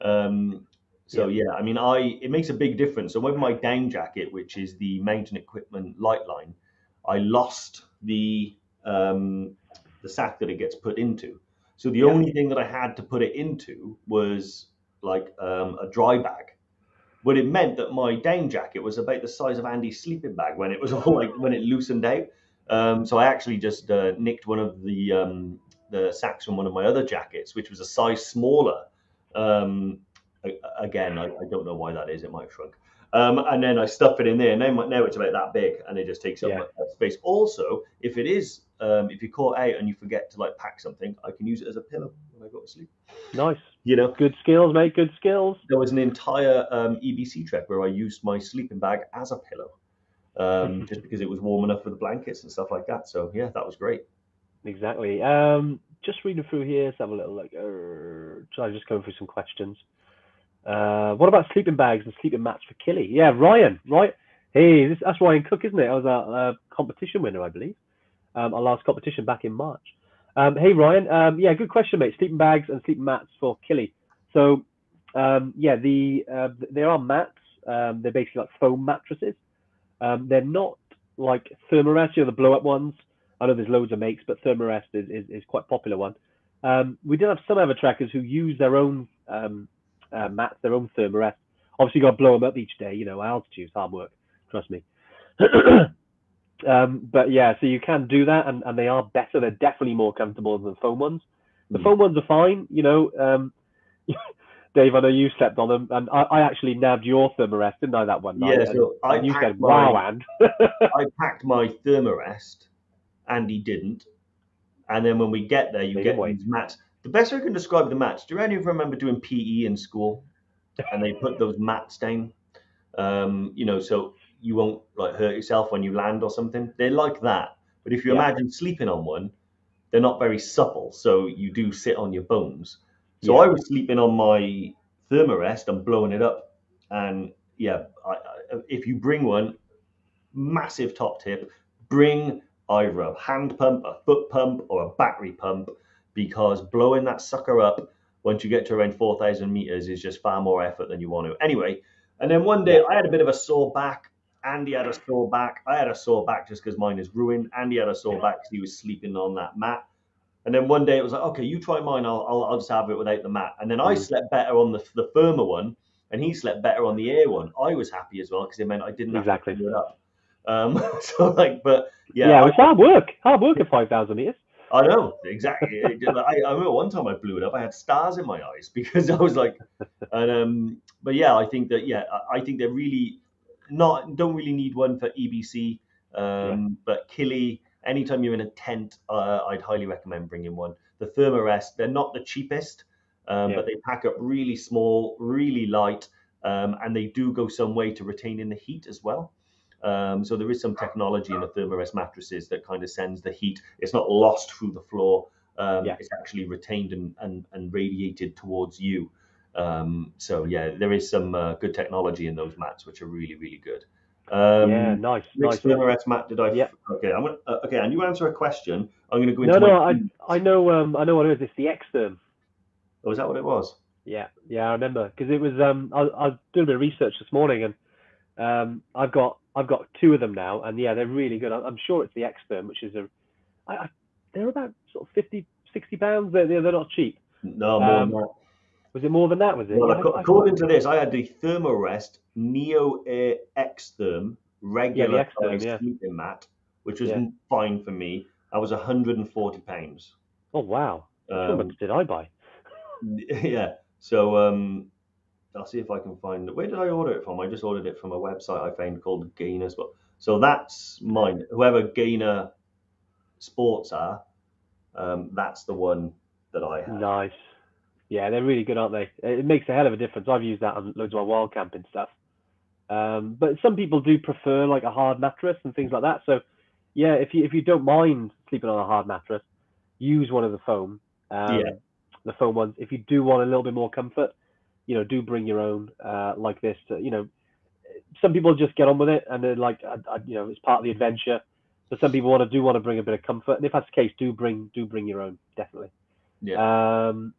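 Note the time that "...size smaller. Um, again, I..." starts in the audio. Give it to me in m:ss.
0:27.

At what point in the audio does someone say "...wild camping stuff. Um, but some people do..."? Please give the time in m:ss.
4:31.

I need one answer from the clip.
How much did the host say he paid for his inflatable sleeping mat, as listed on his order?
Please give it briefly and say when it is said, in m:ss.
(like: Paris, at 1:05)
140 pounds, at 4:08.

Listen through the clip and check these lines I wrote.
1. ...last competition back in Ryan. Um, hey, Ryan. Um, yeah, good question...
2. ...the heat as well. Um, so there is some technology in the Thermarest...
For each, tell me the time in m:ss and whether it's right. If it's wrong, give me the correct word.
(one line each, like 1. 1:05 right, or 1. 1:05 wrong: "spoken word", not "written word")
1. 1:08 wrong: "March", not "Ryan"
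2. 3:18 right.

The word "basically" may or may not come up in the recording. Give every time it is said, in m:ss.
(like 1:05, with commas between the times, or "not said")
1:18.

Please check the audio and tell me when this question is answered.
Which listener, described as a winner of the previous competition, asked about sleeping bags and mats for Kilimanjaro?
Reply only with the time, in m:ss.
1:05.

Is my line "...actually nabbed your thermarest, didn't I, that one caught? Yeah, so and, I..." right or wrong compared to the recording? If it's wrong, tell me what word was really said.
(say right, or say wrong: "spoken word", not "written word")
wrong: "night", not "caught".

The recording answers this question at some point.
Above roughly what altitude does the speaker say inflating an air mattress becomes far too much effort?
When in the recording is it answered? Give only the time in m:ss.
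2:28.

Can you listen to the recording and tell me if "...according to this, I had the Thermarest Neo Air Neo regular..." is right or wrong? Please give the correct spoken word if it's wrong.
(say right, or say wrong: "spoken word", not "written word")
wrong: "Therm", not "Neo".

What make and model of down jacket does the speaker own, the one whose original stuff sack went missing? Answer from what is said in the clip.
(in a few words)
Mountain Equipment Lightline.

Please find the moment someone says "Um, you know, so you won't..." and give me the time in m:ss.
2:02.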